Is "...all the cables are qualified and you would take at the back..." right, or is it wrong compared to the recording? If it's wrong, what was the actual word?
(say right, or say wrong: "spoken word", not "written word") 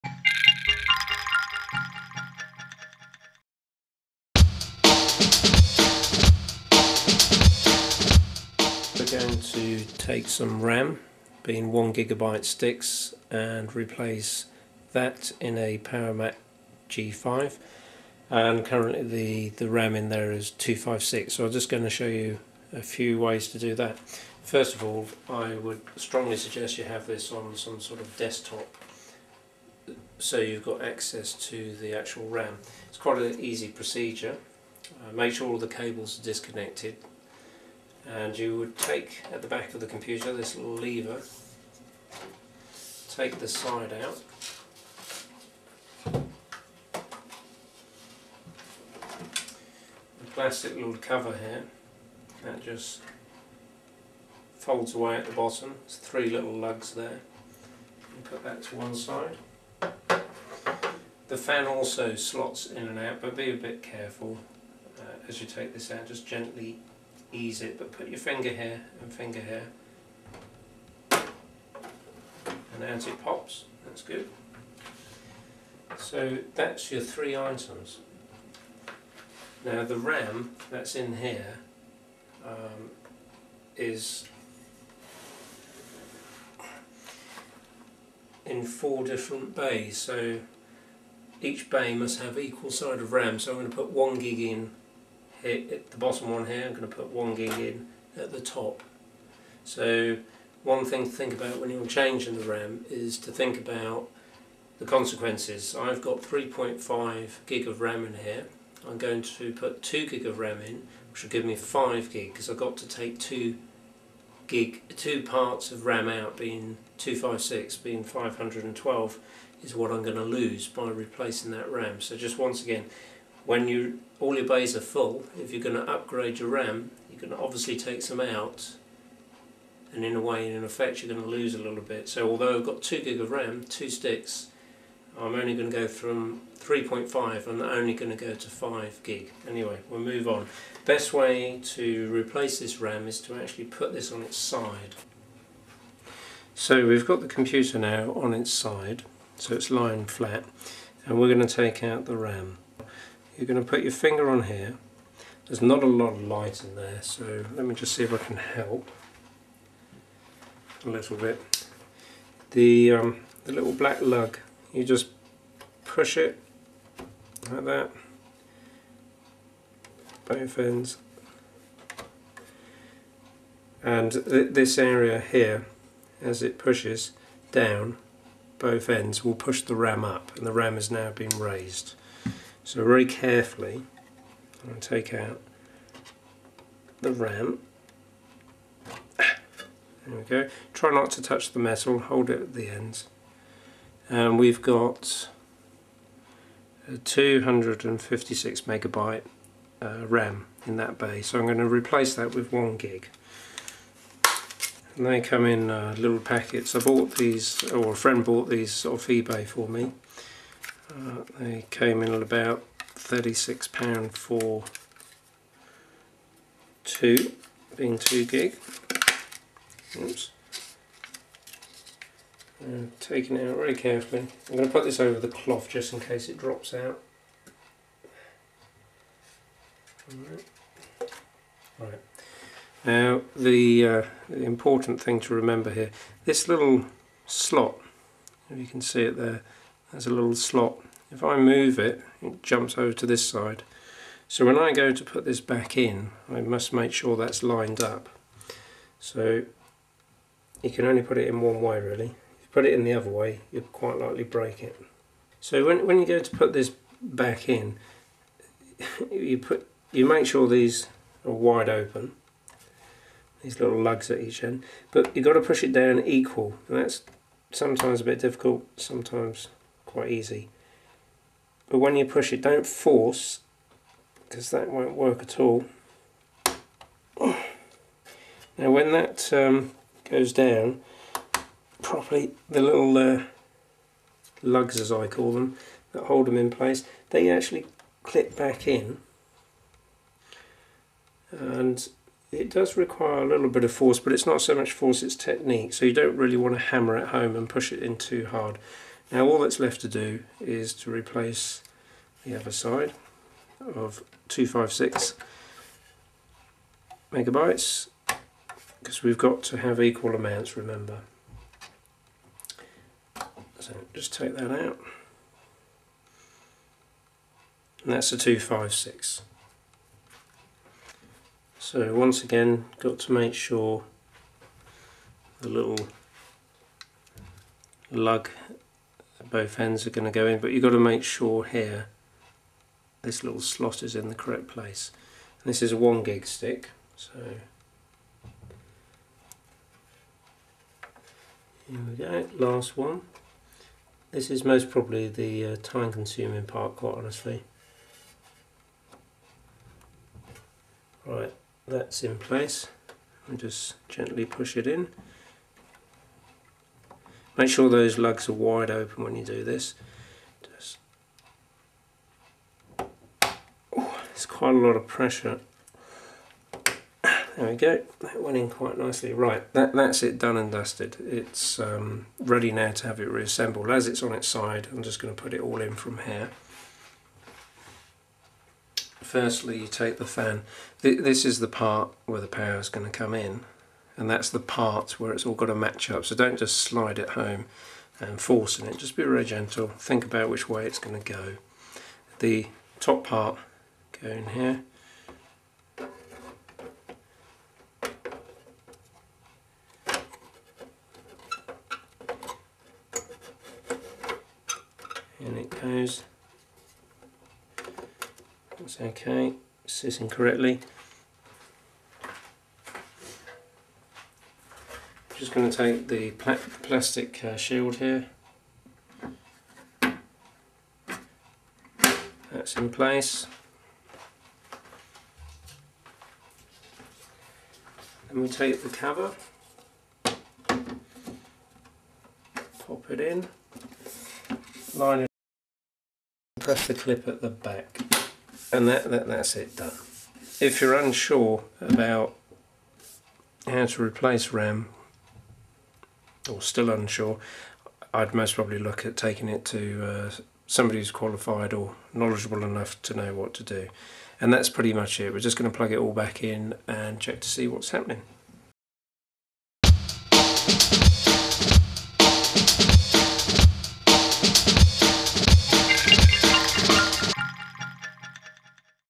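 wrong: "disconnected", not "qualified".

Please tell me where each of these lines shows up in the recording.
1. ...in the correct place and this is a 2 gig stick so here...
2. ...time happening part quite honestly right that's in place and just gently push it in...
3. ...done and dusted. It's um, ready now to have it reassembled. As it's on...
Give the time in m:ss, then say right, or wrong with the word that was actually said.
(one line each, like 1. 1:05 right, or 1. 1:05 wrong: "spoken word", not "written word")
1. 5:33 wrong: "1", not "2"
2. 5:45 wrong: "consuming", not "happening"
3. 6:10 right.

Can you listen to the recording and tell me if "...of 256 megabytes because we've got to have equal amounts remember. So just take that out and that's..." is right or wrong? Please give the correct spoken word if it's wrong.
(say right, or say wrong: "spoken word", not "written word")
right.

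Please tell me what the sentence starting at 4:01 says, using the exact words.
If I move it, it jumps over to this side.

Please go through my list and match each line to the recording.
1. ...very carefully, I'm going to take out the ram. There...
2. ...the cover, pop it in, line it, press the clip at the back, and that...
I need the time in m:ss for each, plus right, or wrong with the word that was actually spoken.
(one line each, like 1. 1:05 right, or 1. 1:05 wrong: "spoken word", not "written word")
1. 3:02 right
2. 7:08 right.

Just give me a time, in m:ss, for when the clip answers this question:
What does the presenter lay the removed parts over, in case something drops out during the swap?
3:45.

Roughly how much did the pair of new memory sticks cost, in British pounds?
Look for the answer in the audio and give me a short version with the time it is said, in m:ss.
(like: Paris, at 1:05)
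£36, at 3:32.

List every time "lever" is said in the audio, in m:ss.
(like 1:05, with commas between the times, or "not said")
0:40.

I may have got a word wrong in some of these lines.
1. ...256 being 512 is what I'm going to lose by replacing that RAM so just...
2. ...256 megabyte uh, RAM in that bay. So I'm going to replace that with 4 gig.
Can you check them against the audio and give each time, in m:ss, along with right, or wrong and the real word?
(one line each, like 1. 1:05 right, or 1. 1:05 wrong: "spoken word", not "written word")
1. 1:56 right
2. 3:16 wrong: "1", not "4".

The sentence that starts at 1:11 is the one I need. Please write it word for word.
And as it pops, that's good.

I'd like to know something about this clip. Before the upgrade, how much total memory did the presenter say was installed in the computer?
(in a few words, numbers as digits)
3.5 gig.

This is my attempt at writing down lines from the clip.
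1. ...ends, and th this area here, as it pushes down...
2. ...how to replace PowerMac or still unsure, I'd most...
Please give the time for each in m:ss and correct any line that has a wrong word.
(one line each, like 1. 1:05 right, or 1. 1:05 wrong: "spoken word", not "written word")
1. 2:50 right
2. 7:23 wrong: "RAM", not "PowerMac".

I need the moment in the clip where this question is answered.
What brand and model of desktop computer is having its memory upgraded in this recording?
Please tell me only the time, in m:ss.
0:15.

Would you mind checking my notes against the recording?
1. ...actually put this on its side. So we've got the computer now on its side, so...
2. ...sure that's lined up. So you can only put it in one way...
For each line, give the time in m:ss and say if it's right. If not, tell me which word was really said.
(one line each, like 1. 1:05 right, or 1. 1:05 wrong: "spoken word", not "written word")
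1. 2:23 right
2. 4:06 right.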